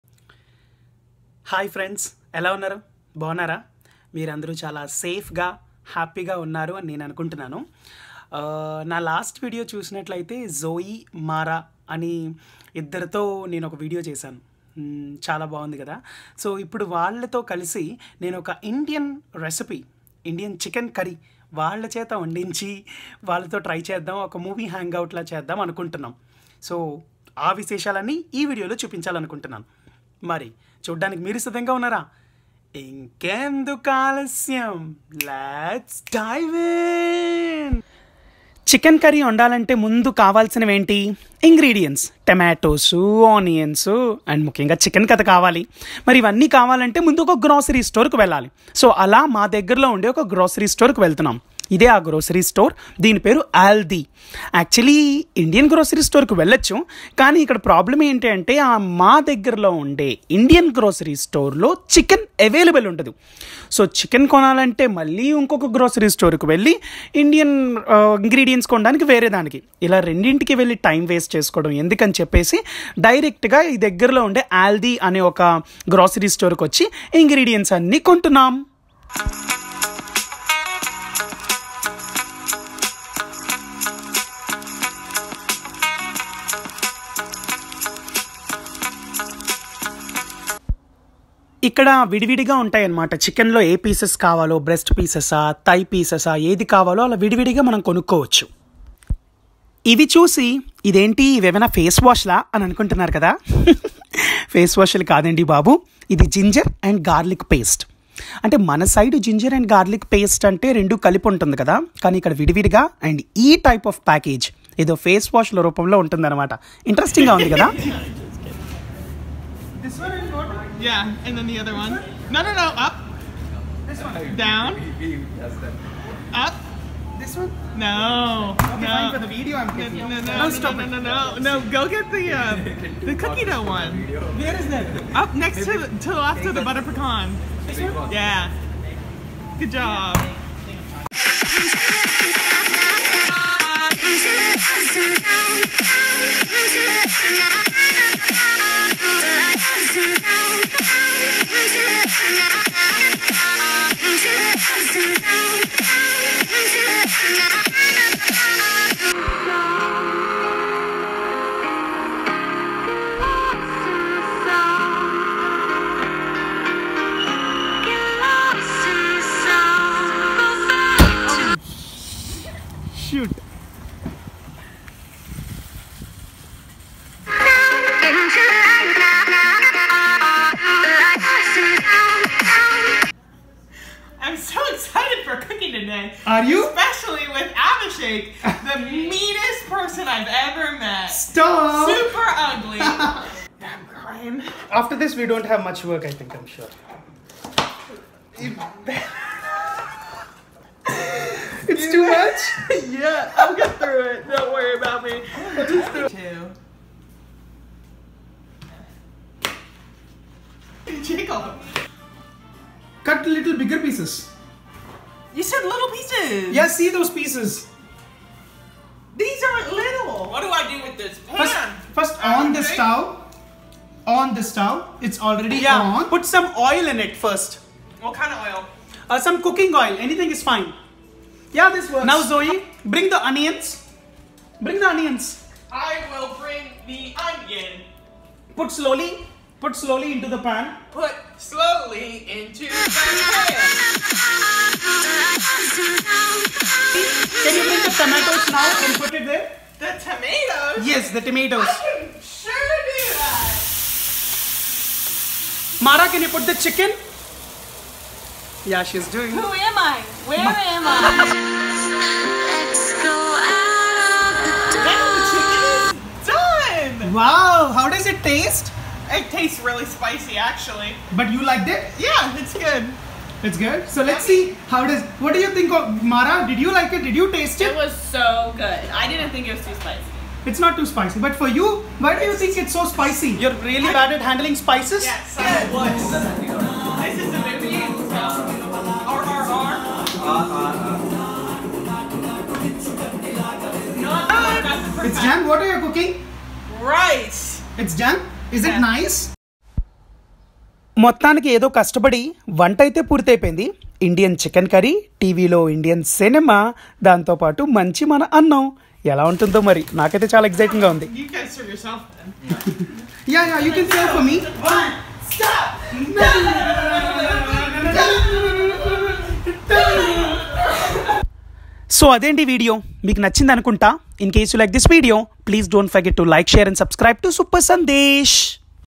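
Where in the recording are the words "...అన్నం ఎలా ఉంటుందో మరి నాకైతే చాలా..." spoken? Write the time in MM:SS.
05:08.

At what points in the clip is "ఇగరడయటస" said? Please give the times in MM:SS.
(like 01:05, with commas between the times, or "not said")
00:41, 01:08, 01:17.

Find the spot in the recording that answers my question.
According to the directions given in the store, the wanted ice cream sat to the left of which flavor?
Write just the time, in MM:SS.
02:16.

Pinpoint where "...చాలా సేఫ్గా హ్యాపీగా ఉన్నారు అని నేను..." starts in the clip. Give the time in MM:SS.
00:04.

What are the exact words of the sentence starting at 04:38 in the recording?
I didn't think it was too spicy.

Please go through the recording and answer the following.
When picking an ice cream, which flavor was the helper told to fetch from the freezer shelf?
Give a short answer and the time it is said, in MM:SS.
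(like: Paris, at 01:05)
Cookie dough, at 02:13.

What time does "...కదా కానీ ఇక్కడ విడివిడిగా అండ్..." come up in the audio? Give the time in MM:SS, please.
01:51.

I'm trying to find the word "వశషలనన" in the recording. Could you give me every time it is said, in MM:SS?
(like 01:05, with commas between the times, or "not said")
00:27.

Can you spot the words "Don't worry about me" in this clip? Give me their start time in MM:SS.
03:24.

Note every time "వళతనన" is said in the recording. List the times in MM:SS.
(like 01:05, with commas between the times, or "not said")
00:51.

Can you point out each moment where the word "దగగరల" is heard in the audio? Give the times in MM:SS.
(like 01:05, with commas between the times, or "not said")
00:49, 00:59, 01:13.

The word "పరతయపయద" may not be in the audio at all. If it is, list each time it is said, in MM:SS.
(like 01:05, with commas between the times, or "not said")
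05:03.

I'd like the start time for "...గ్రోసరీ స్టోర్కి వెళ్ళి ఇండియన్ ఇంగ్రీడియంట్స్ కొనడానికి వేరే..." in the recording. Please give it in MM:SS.
01:05.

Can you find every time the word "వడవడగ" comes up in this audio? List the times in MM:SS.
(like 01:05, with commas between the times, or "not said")
01:32, 01:37, 01:52.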